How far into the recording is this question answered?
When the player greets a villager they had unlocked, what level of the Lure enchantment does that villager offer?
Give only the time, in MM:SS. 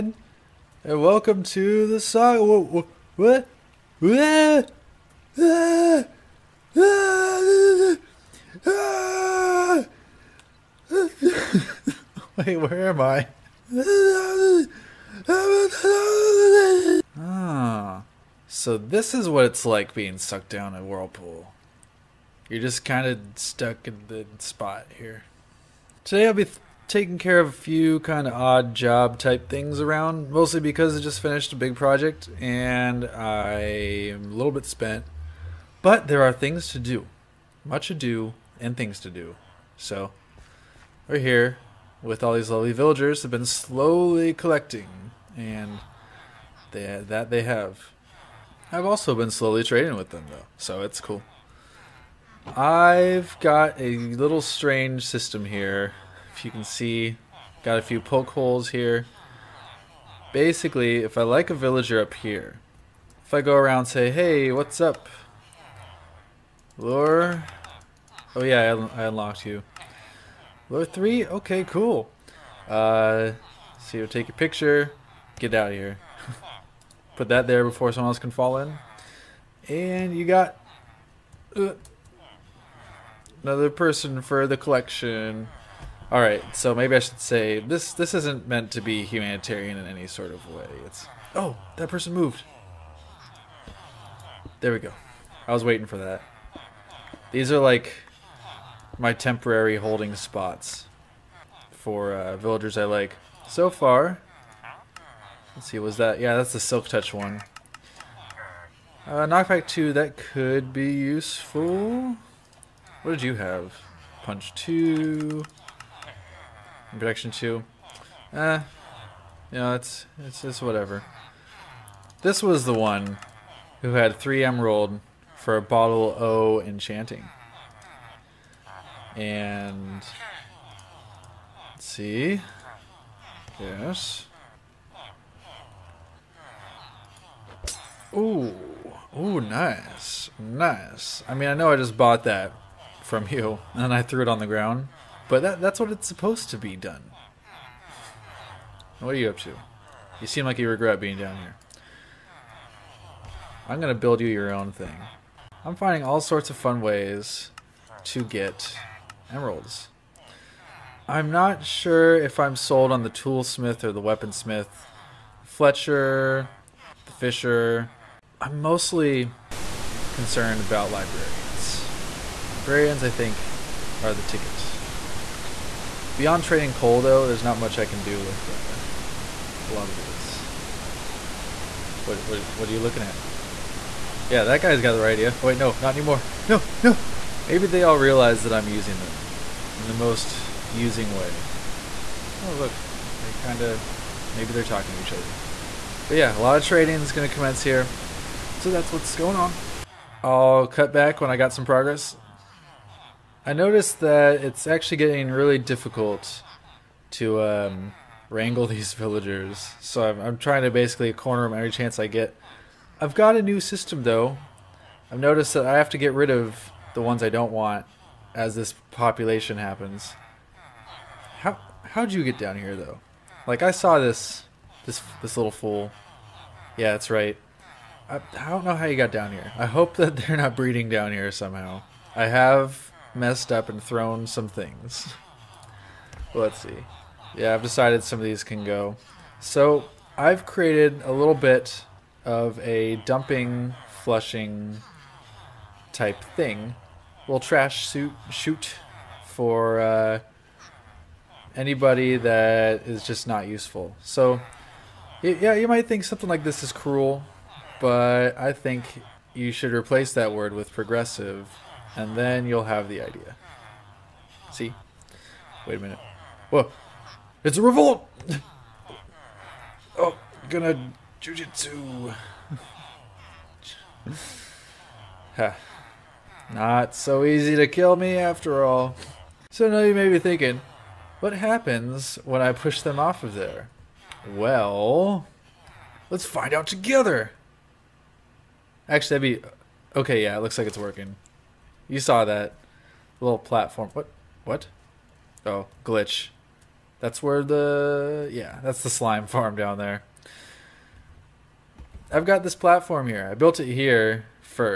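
01:10.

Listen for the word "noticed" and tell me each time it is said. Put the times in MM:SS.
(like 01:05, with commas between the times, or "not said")
03:23, 03:35.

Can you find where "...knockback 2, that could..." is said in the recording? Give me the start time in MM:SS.
01:49.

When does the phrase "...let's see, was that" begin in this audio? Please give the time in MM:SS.
01:45.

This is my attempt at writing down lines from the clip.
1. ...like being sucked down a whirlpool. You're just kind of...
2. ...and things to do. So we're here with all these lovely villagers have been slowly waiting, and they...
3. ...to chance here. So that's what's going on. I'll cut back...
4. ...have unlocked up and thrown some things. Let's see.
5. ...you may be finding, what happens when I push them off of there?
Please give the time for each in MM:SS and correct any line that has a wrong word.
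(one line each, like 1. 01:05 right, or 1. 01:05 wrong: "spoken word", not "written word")
1. 00:19 right
2. 00:38 wrong: "collecting", not "waiting"
3. 03:17 wrong: "commence", not "chance"
4. 03:52 wrong: "messed", not "unlocked"
5. 04:39 wrong: "thinking", not "finding".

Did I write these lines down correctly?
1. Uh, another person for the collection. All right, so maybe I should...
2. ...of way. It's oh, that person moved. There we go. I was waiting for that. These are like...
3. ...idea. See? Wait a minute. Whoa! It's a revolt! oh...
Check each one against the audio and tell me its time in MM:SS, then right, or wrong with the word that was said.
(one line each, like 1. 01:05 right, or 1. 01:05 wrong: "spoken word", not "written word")
1. 01:21 right
2. 01:30 right
3. 04:23 right.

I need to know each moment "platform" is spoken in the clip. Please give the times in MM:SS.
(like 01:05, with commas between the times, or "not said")
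04:53, 05:02.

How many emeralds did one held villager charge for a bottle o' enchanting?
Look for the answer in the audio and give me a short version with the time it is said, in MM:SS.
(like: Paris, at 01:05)
3, at 02:04.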